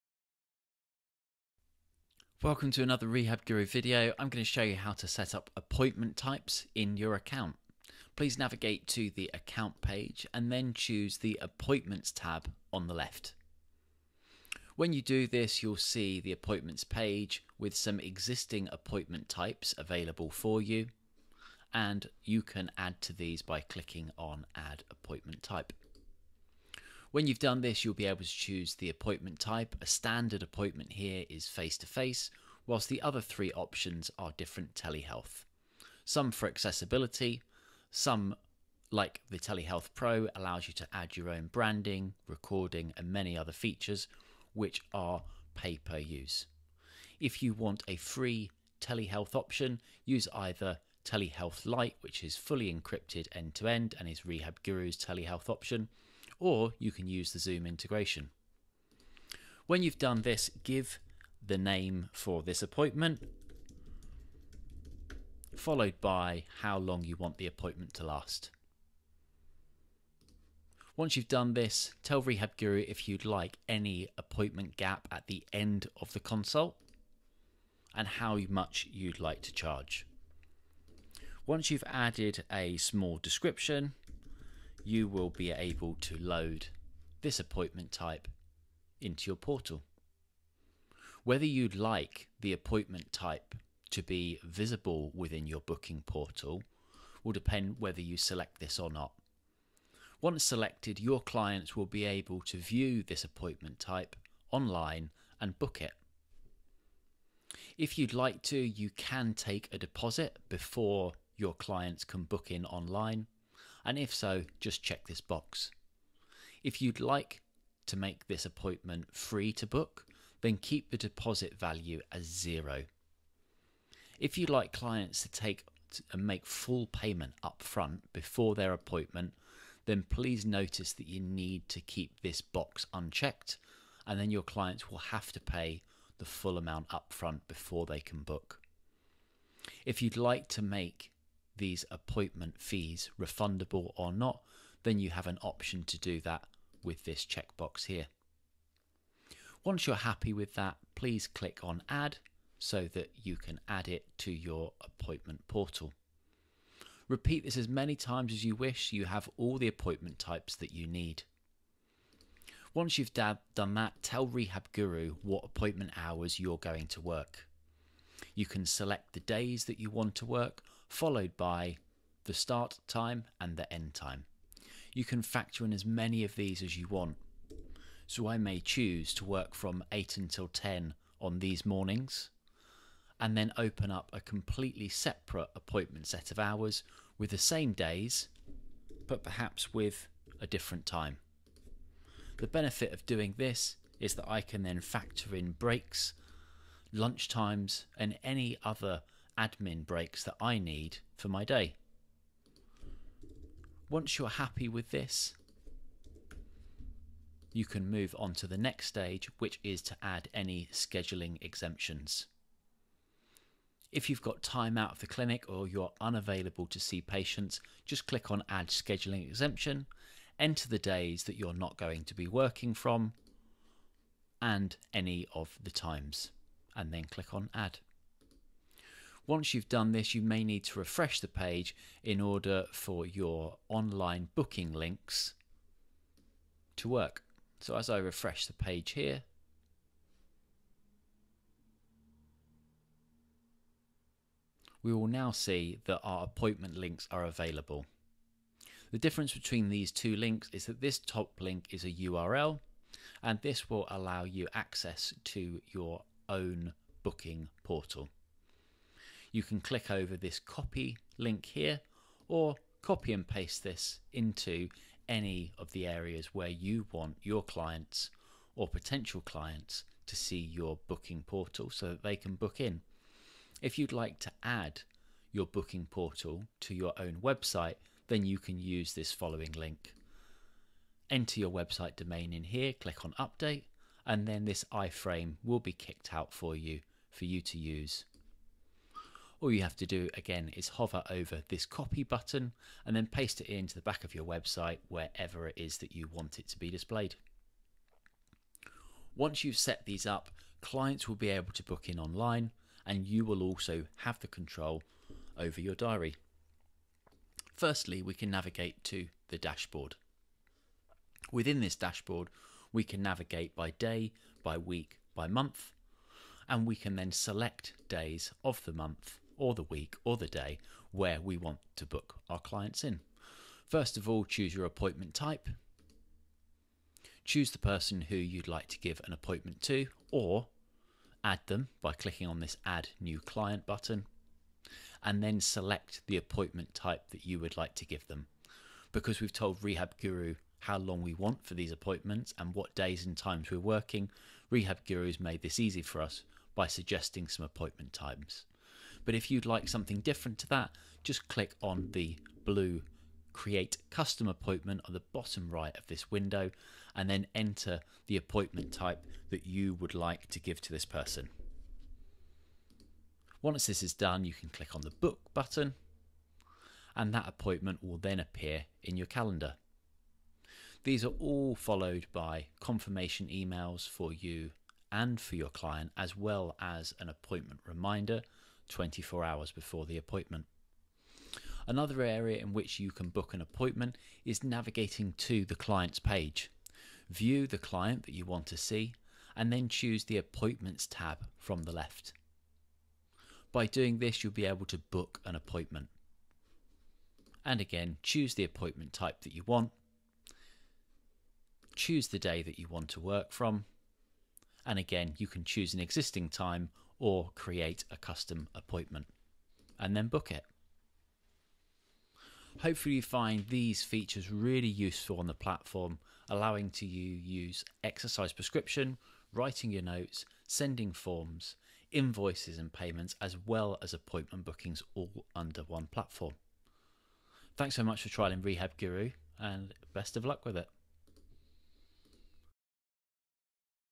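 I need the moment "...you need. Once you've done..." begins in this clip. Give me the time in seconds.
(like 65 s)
160 s.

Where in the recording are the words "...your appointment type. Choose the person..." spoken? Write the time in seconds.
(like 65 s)
324 s.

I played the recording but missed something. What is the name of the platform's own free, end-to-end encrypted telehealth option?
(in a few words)
Telehealth Lite.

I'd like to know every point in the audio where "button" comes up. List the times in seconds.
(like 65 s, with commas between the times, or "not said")
292 s, 333 s, 365 s.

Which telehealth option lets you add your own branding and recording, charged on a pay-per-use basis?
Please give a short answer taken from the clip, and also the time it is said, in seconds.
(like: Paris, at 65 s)
Telehealth Pro, at 39 s.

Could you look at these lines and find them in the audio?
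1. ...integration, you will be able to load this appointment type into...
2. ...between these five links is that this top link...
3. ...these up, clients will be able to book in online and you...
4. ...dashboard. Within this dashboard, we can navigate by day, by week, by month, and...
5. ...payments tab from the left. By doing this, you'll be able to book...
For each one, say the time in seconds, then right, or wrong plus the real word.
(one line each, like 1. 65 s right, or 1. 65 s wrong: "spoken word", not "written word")
1. 83 s wrong: "description", not "integration"
2. 249 s wrong: "two", not "five"
3. 299 s right
4. 309 s right
5. 390 s wrong: "appointments", not "payments".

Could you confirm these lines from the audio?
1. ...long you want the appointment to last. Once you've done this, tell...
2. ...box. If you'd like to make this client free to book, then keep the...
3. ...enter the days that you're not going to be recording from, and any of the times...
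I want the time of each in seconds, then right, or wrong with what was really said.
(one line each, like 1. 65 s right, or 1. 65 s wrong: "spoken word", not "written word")
1. 66 s right
2. 115 s wrong: "appointment", not "client"
3. 220 s wrong: "working", not "recording".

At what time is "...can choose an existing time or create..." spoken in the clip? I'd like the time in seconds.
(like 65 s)
405 s.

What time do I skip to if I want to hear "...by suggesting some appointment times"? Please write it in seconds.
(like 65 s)
346 s.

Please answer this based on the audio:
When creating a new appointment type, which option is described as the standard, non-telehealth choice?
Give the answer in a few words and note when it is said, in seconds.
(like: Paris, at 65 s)
Face to face, at 31 s.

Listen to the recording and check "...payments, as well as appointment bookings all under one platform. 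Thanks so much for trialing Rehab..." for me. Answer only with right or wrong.
right.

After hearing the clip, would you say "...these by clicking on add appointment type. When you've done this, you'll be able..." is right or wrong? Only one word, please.
right.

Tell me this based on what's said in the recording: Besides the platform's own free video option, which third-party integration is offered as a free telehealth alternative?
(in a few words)
Zoom.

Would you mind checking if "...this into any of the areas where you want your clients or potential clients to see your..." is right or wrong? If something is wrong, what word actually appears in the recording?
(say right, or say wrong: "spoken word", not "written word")
right.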